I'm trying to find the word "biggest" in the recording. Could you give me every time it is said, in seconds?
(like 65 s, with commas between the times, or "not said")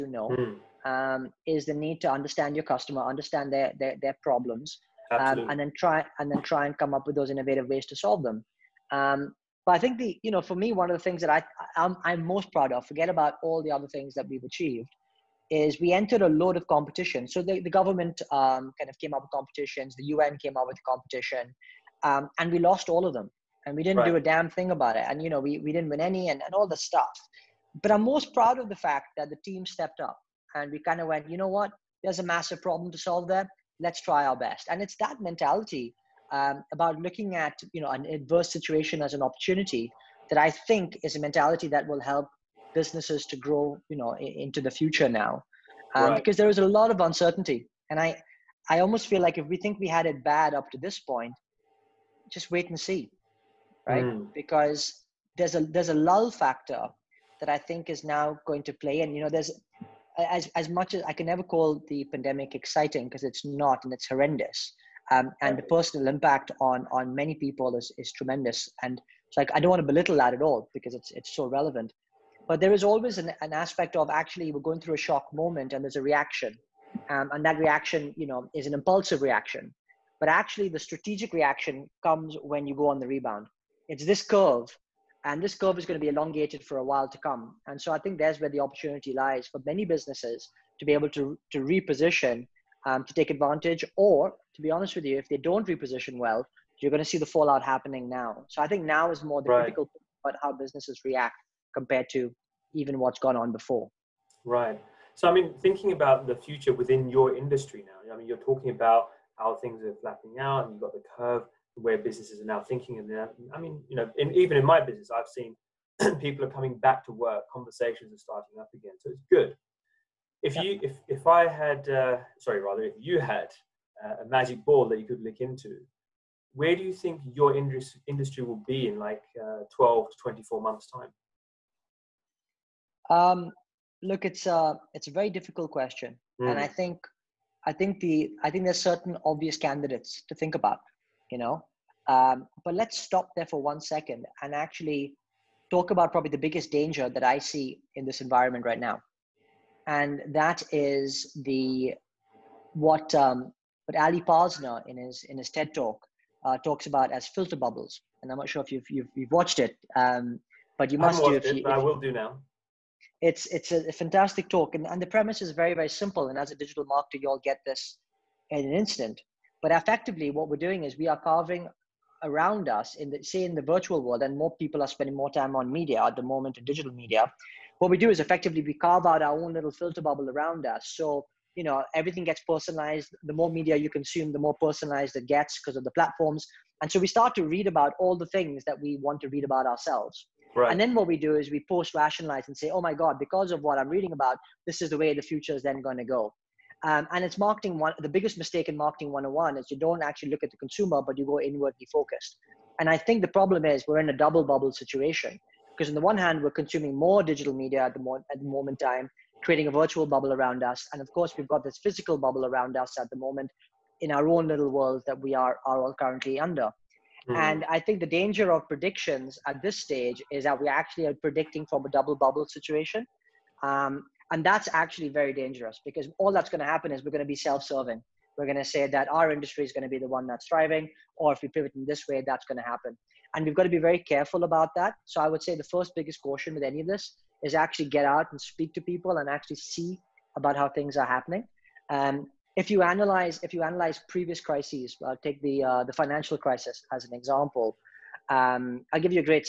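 146 s, 198 s, 235 s.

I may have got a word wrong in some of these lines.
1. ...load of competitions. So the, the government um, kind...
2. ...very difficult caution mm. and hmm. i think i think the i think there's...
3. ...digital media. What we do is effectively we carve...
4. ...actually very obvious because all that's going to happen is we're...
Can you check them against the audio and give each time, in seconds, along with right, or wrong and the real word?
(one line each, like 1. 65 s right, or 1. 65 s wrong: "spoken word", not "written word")
1. 16 s right
2. 135 s wrong: "question", not "caution"
3. 176 s right
4. 224 s wrong: "dangerous", not "obvious".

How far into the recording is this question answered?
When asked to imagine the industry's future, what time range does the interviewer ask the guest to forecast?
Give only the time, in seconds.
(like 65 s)
129 s.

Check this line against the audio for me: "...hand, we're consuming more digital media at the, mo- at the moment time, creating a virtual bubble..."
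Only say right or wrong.
right.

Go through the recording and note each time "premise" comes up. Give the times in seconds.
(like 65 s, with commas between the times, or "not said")
165 s.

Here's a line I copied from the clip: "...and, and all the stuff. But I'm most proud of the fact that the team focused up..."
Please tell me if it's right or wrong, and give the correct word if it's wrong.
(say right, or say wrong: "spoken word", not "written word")
wrong: "stepped", not "focused".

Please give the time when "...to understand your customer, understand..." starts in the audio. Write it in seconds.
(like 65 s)
2 s.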